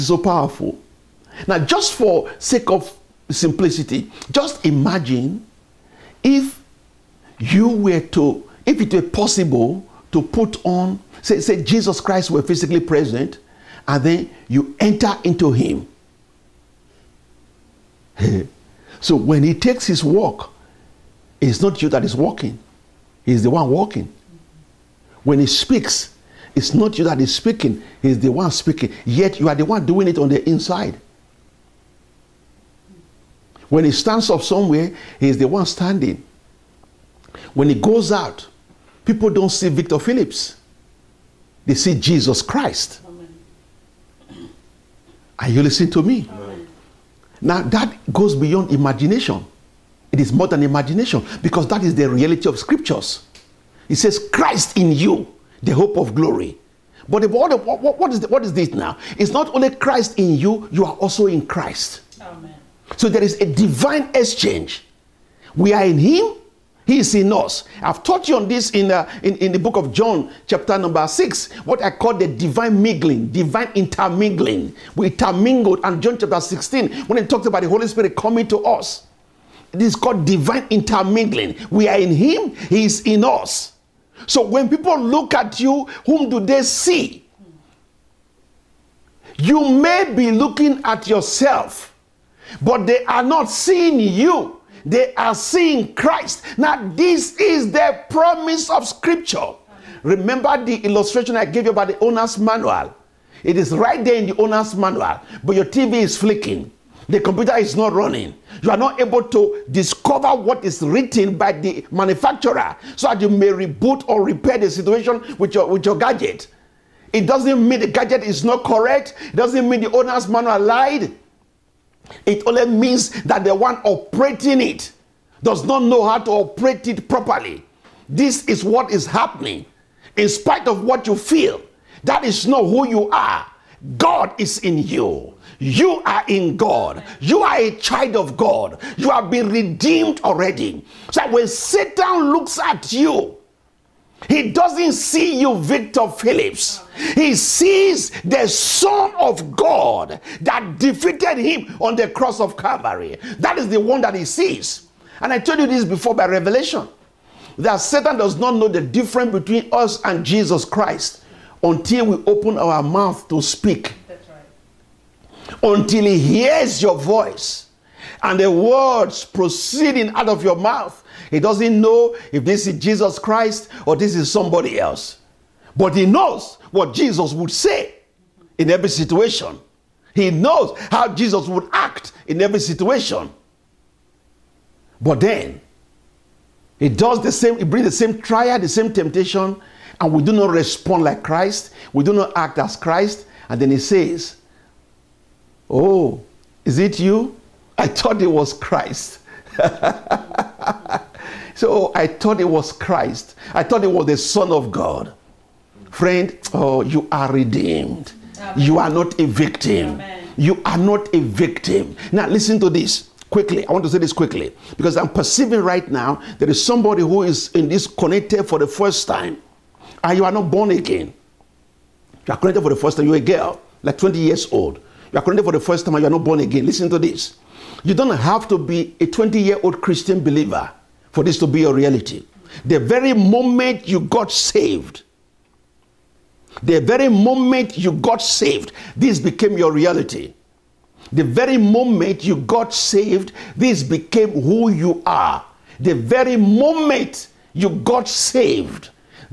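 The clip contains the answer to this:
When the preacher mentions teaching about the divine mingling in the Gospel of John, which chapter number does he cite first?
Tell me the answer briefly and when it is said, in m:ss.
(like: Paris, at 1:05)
6, at 1:11.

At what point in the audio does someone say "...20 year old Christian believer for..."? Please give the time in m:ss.
3:49.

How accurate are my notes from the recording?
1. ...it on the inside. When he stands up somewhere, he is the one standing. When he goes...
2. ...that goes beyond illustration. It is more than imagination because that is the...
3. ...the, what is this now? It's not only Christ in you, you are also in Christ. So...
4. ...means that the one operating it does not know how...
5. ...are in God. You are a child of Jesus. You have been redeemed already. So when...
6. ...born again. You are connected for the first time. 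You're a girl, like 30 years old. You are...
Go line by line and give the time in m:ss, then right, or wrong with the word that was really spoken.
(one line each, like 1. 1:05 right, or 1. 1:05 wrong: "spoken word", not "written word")
1. 0:30 right
2. 0:47 wrong: "imagination", not "illustration"
3. 0:58 right
4. 2:02 right
5. 2:16 wrong: "God", not "Jesus"
6. 3:40 wrong: "20", not "30".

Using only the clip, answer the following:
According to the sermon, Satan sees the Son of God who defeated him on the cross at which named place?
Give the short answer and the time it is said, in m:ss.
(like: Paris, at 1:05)
Calvary, at 2:32.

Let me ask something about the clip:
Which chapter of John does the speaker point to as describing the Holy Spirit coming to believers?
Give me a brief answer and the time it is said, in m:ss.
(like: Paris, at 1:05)
16, at 1:16.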